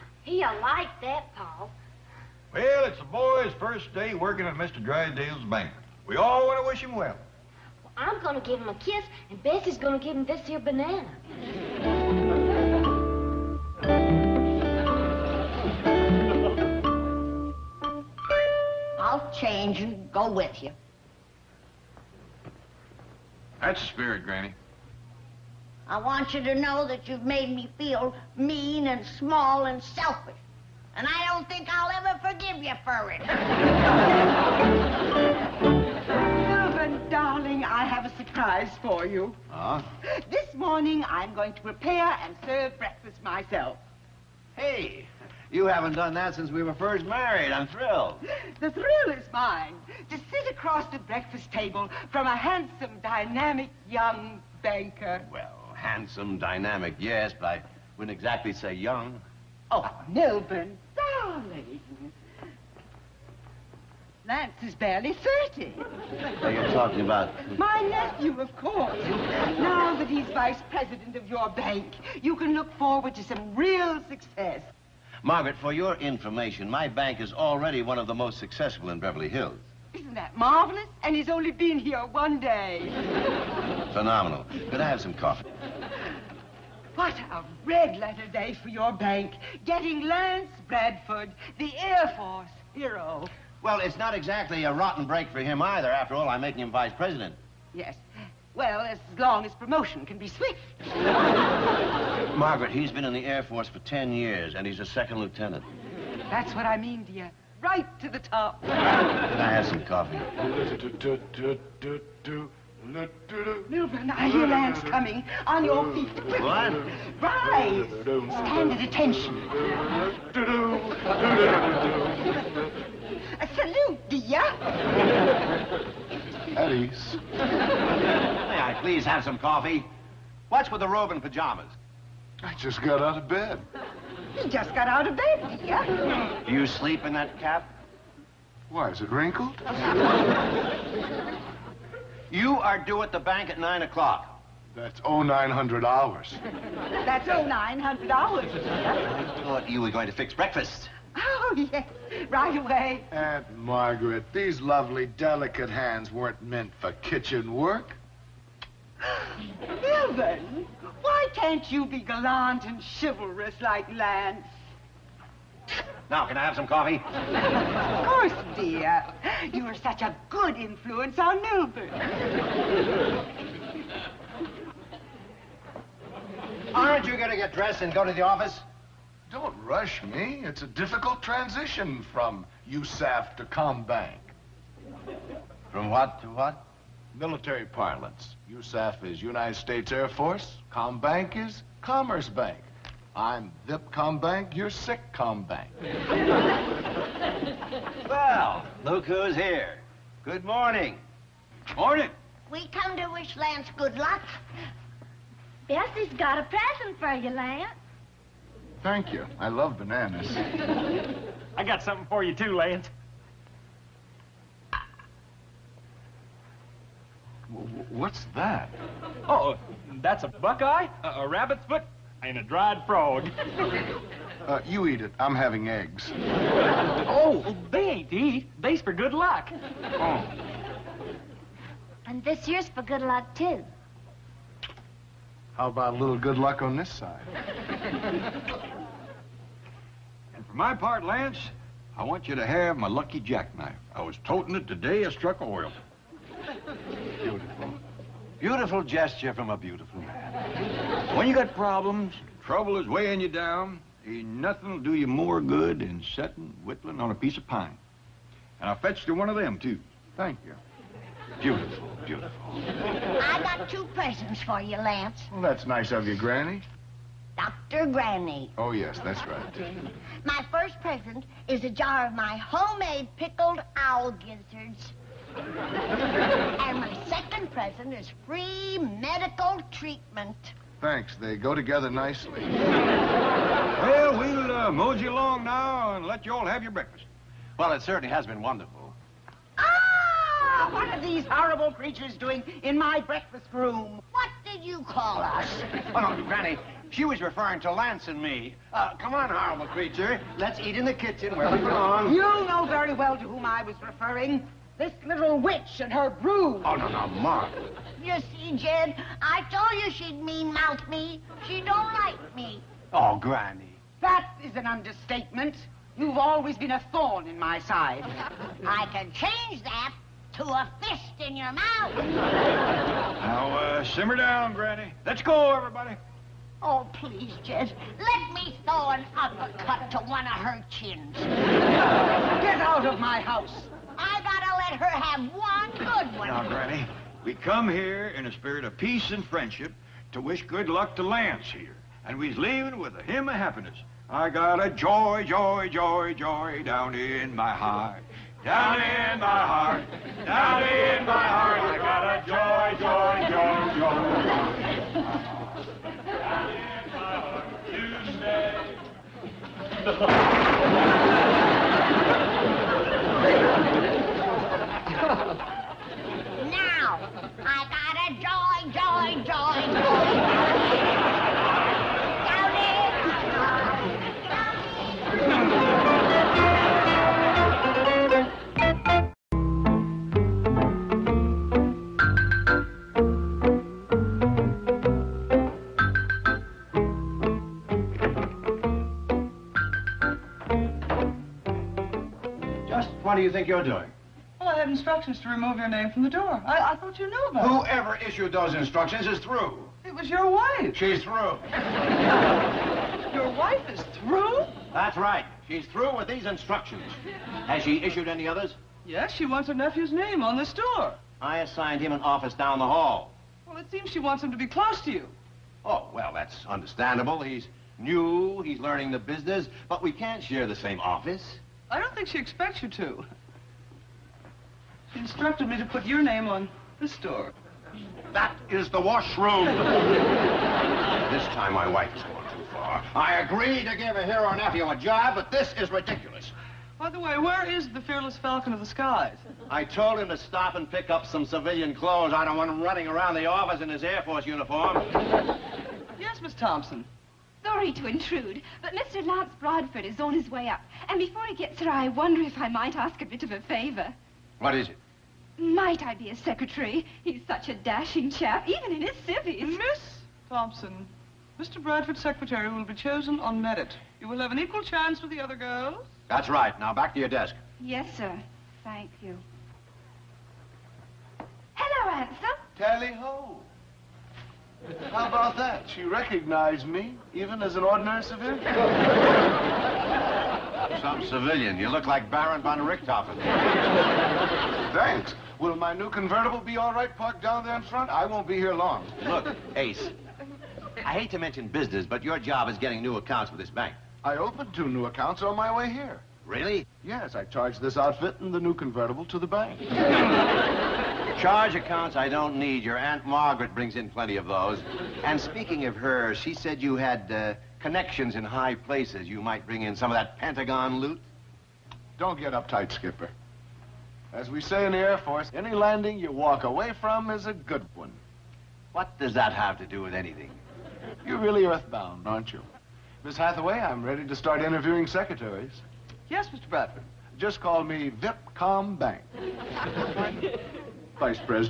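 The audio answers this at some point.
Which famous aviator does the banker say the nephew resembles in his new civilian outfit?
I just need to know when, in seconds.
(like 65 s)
482 s.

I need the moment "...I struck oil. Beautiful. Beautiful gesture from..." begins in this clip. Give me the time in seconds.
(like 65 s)
245 s.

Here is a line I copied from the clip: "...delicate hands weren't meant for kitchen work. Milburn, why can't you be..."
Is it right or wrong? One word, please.
right.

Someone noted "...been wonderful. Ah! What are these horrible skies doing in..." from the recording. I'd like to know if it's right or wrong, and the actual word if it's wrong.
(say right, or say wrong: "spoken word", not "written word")
wrong: "creatures", not "skies".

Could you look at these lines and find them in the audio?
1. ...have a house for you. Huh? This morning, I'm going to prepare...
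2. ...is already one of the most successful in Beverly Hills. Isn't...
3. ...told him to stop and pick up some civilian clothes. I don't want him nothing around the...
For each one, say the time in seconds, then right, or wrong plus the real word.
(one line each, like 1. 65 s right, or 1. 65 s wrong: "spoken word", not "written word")
1. 37 s wrong: "surprise", not "house"
2. 77 s right
3. 439 s wrong: "running", not "nothing".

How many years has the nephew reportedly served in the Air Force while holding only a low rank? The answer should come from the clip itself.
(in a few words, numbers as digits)
10.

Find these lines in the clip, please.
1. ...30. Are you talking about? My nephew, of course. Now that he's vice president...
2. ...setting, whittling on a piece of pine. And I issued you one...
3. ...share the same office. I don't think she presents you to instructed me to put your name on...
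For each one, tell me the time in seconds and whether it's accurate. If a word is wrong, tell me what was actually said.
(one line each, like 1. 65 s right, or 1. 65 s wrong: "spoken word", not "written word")
1. 65 s right
2. 256 s wrong: "fetched", not "issued"
3. 420 s wrong: "expects", not "presents".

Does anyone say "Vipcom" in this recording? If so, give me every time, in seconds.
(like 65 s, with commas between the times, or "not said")
193 s, 527 s.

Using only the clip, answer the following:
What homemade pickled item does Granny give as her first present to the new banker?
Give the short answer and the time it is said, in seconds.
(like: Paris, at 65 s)
Owl gizzards, at 273 s.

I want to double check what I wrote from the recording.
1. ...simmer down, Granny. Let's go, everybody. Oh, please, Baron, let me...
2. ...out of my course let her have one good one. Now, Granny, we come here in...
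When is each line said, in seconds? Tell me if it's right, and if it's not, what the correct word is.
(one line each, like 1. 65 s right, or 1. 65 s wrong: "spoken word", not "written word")
1. 323 s wrong: "Jed", not "Baron"
2. 332 s wrong: "house", not "course".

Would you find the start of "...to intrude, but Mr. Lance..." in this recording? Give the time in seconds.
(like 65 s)
447 s.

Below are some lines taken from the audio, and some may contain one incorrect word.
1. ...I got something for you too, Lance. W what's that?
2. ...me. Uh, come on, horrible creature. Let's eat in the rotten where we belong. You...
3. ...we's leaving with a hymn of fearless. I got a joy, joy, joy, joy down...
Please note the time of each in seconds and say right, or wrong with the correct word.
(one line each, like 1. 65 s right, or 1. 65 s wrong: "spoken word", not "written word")
1. 211 s right
2. 298 s wrong: "kitchen", not "rotten"
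3. 342 s wrong: "happiness", not "fearless".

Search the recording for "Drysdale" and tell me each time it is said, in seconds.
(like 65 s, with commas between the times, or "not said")
4 s.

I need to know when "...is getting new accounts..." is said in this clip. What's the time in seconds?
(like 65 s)
492 s.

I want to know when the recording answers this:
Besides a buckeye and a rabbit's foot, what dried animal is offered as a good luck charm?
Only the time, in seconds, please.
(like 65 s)
222 s.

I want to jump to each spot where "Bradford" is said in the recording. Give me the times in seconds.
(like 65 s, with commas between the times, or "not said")
90 s, 449 s, 461 s, 526 s.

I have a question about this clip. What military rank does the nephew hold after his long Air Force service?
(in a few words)
Second lieutenant.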